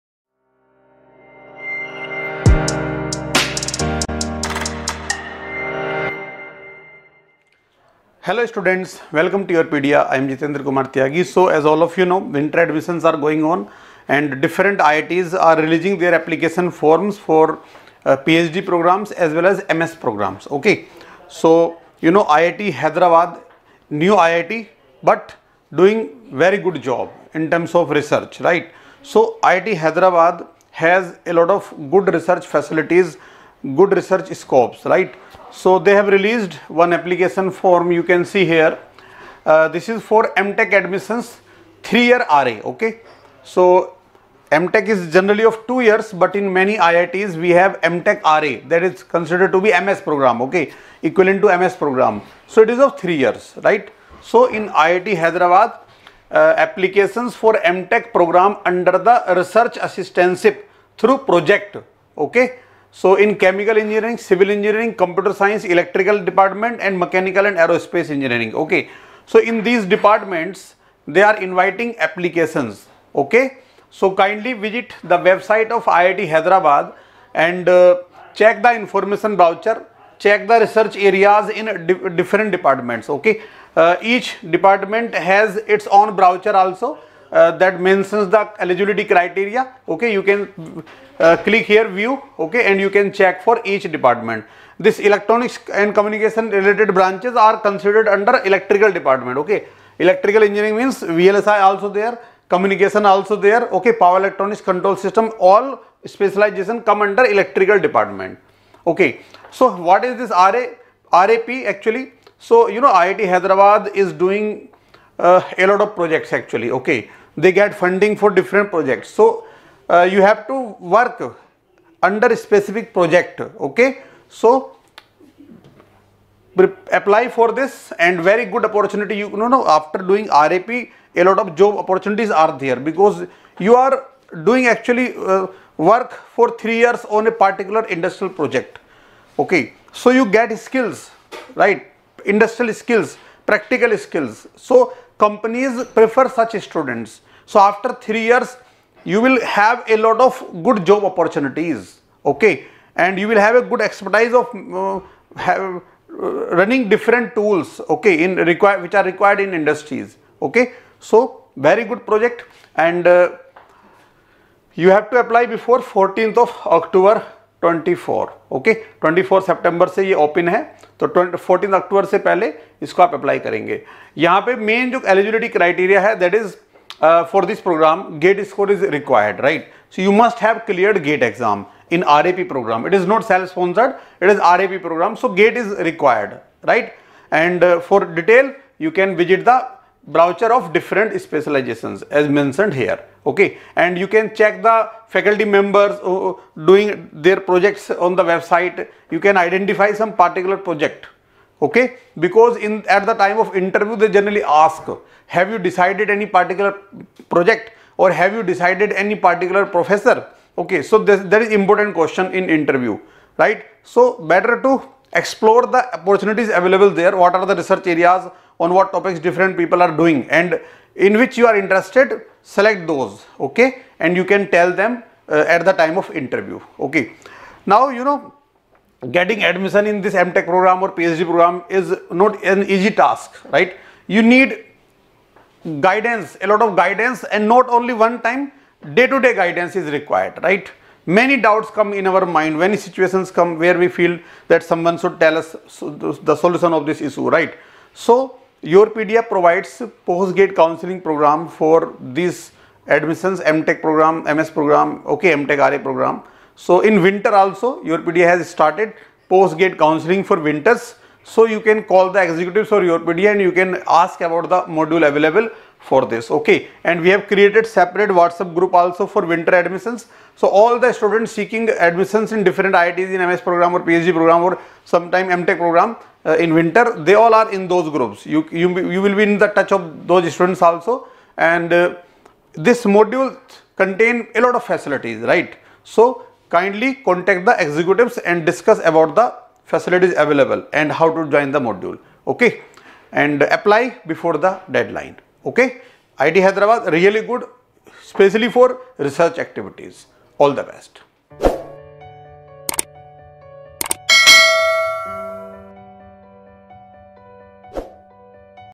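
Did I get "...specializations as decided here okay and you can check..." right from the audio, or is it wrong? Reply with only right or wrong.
wrong.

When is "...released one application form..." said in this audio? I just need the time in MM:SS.
00:36.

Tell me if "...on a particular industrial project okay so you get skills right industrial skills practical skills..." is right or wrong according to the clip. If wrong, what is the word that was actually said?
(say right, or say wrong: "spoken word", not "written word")
right.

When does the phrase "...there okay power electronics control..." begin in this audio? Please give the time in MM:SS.
01:43.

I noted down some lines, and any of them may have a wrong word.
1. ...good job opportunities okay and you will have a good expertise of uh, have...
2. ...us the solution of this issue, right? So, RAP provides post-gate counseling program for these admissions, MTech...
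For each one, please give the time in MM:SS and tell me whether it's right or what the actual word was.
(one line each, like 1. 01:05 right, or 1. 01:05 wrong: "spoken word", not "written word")
1. 02:30 right
2. 04:05 wrong: "YourPedia", not "RAP".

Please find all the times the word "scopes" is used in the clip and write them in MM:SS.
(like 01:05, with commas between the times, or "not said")
00:34.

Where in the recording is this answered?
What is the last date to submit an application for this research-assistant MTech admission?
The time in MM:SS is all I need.
02:45.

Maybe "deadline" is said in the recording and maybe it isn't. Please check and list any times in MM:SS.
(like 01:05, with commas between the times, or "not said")
04:54.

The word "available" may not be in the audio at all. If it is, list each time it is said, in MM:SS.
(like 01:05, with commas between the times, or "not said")
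03:36, 04:25, 04:50.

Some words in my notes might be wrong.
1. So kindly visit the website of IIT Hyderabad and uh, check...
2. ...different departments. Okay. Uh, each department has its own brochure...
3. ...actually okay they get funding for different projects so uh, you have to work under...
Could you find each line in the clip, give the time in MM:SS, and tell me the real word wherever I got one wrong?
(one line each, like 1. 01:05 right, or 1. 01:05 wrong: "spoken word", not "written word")
1. 01:13 right
2. 01:22 right
3. 01:56 right.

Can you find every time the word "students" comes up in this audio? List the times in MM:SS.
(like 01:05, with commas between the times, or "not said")
00:08, 02:26, 04:30, 04:40.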